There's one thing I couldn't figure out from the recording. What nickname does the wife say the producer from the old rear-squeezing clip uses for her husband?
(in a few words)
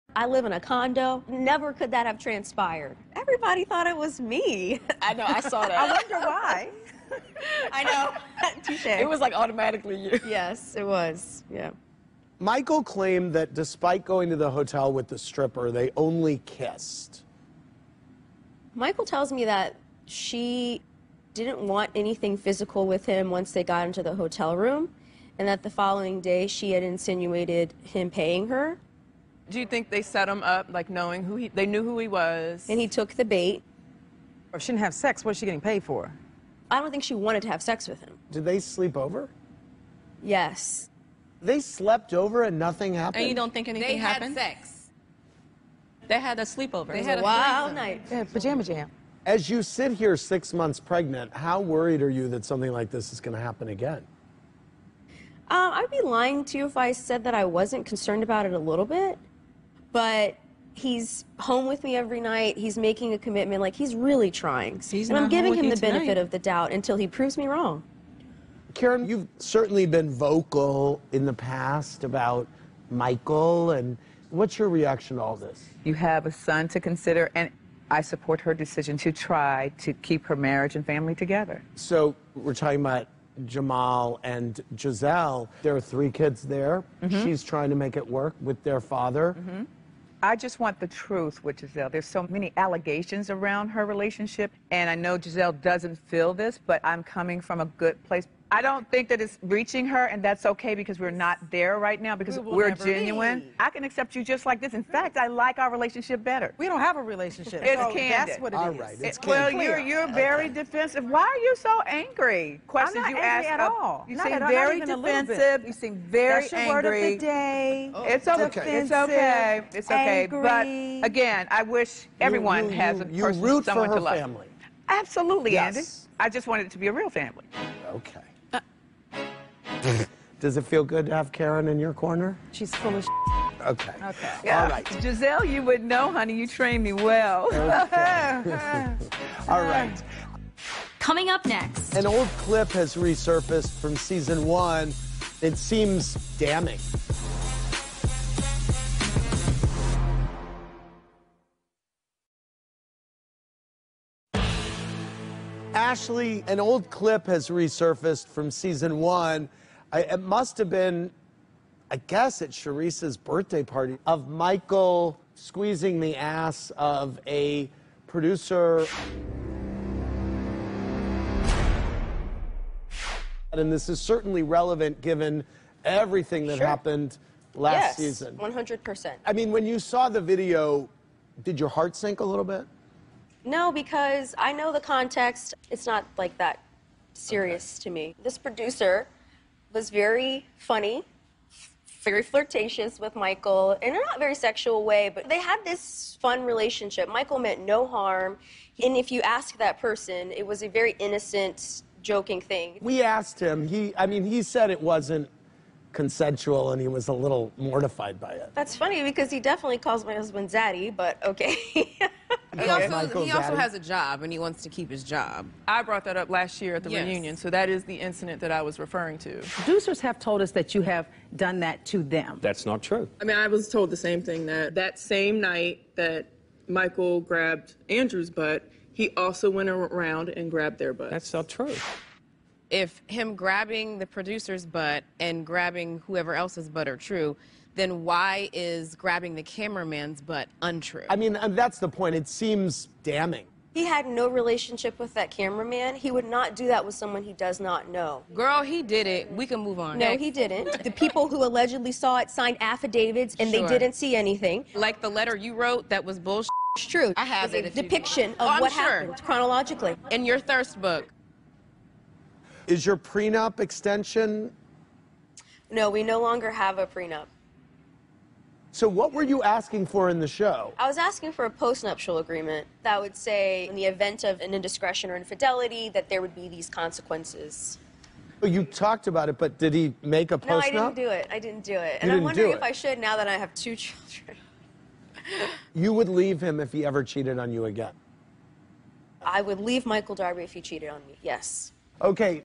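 Zaddy.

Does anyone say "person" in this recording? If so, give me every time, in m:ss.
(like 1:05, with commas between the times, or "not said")
2:03, 3:19.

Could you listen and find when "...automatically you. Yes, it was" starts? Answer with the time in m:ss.
0:09.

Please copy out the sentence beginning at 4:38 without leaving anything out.
Oh, you talked about it, but did he make a post?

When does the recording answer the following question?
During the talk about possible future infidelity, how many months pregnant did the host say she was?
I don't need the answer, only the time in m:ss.
0:50.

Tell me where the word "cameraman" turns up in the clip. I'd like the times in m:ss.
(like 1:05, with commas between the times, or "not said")
3:59, 4:05.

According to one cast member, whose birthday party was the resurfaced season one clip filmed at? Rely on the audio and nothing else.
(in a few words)
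Charrisse.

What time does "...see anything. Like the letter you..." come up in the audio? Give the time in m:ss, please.
4:13.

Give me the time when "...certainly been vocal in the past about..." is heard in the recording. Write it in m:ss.
1:09.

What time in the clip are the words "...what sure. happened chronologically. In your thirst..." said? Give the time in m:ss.
4:18.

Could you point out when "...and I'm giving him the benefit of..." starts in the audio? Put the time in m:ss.
1:05.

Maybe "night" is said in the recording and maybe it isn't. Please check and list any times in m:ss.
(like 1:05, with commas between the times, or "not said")
0:47, 1:02, 3:45.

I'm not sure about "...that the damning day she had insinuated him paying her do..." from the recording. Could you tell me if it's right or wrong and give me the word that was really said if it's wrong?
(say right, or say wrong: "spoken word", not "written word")
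wrong: "following", not "damning".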